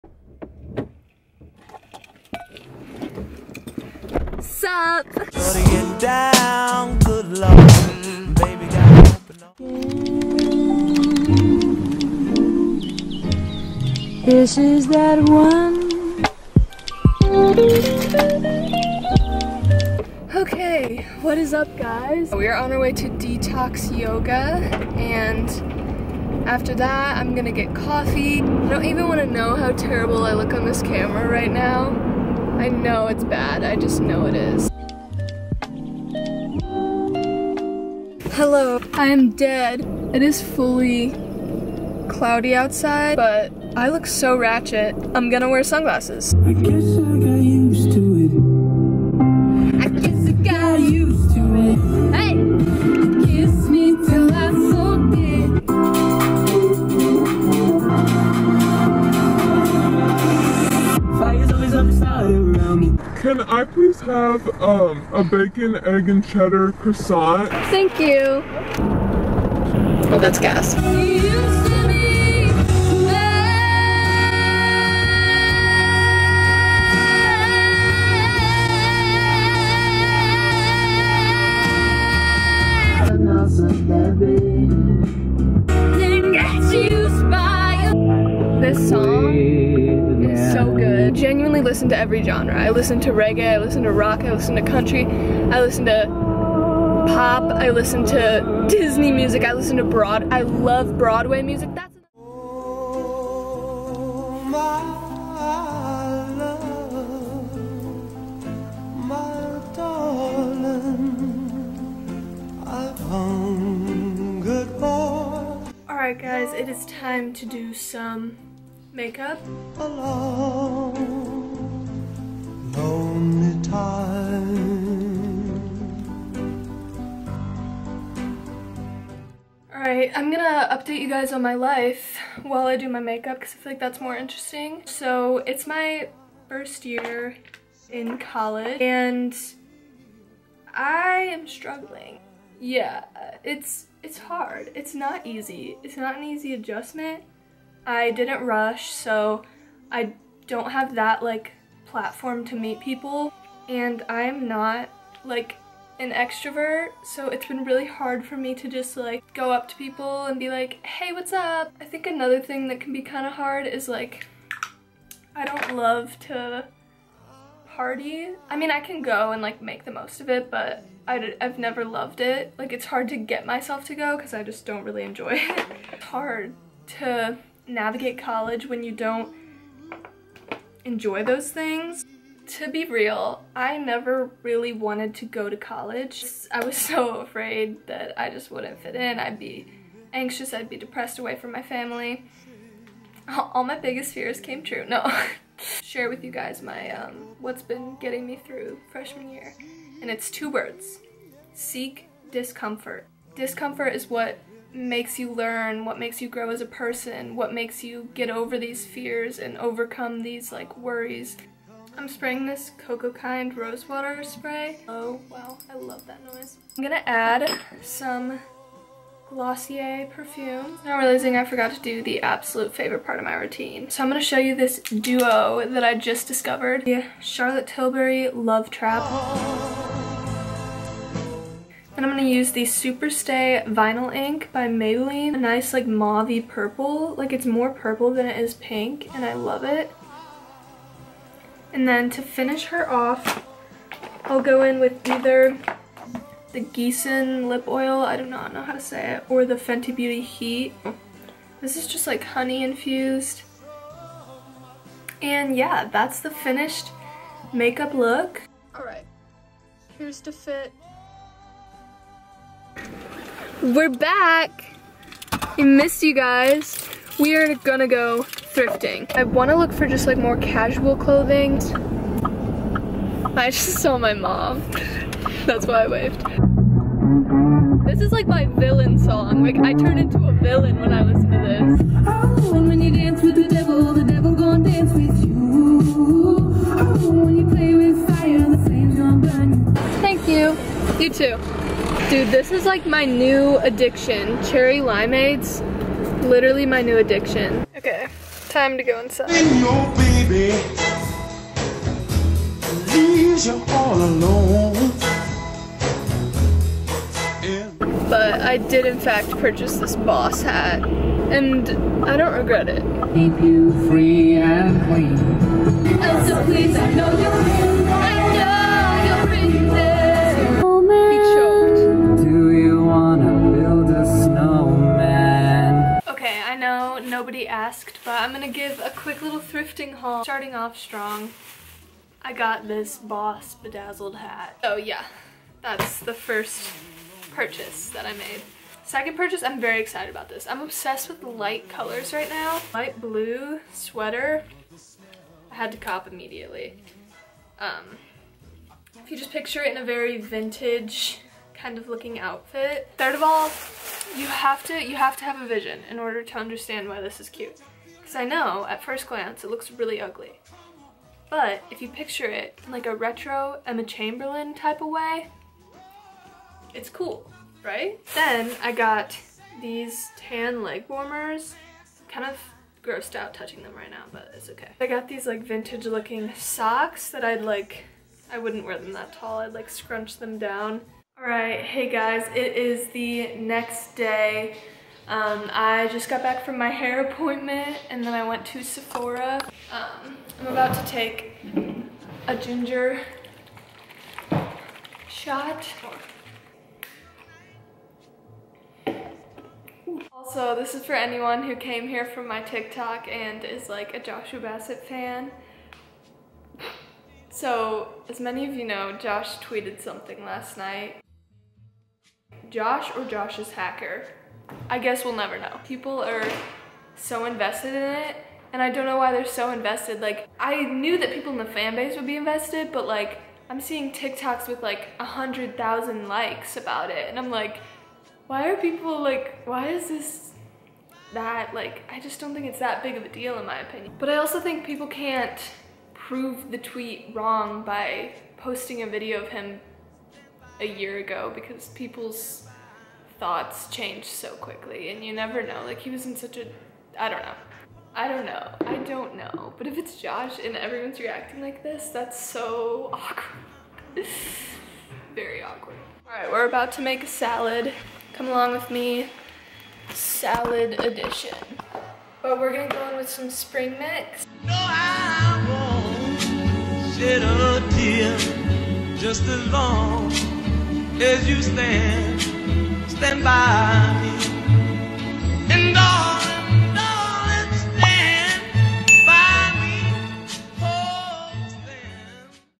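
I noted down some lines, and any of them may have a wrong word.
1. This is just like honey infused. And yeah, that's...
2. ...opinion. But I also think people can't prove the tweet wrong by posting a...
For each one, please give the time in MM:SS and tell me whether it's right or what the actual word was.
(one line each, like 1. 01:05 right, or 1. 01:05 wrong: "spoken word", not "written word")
1. 04:11 right
2. 07:13 right.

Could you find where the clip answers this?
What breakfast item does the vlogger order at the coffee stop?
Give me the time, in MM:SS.
01:05.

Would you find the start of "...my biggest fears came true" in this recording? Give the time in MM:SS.
03:13.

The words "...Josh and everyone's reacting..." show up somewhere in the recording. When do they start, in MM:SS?
07:29.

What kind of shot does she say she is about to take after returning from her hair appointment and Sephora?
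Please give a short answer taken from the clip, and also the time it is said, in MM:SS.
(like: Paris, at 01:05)
Ginger shot, at 06:32.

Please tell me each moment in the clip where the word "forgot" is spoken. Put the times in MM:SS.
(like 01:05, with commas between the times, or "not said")
03:41.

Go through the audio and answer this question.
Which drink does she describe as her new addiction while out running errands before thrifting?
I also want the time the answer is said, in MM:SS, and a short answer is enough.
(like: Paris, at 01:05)
Cherry limeades, at 04:54.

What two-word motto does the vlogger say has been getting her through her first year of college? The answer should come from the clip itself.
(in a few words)
Seek discomfort.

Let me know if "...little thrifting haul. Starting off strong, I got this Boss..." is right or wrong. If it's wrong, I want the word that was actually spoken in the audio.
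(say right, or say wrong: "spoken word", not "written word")
right.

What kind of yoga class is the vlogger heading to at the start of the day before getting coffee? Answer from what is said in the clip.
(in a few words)
Detox yoga.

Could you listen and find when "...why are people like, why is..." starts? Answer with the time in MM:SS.
07:08.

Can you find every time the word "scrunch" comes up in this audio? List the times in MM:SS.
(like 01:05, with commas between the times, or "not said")
06:19.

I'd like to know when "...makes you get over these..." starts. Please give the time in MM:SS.
03:27.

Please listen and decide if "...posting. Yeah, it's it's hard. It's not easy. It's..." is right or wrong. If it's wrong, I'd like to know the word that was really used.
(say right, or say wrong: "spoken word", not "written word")
wrong: "struggling", not "posting".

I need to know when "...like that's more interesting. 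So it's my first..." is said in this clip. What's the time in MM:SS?
02:13.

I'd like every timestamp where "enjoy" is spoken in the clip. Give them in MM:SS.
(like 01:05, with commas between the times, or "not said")
02:55, 03:00.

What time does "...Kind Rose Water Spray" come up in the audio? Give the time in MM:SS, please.
03:33.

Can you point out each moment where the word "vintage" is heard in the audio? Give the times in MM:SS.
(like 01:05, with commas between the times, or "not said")
05:50, 06:15.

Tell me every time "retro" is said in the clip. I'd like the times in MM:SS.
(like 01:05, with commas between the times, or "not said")
06:02.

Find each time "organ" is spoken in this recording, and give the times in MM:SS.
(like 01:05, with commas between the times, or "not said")
not said.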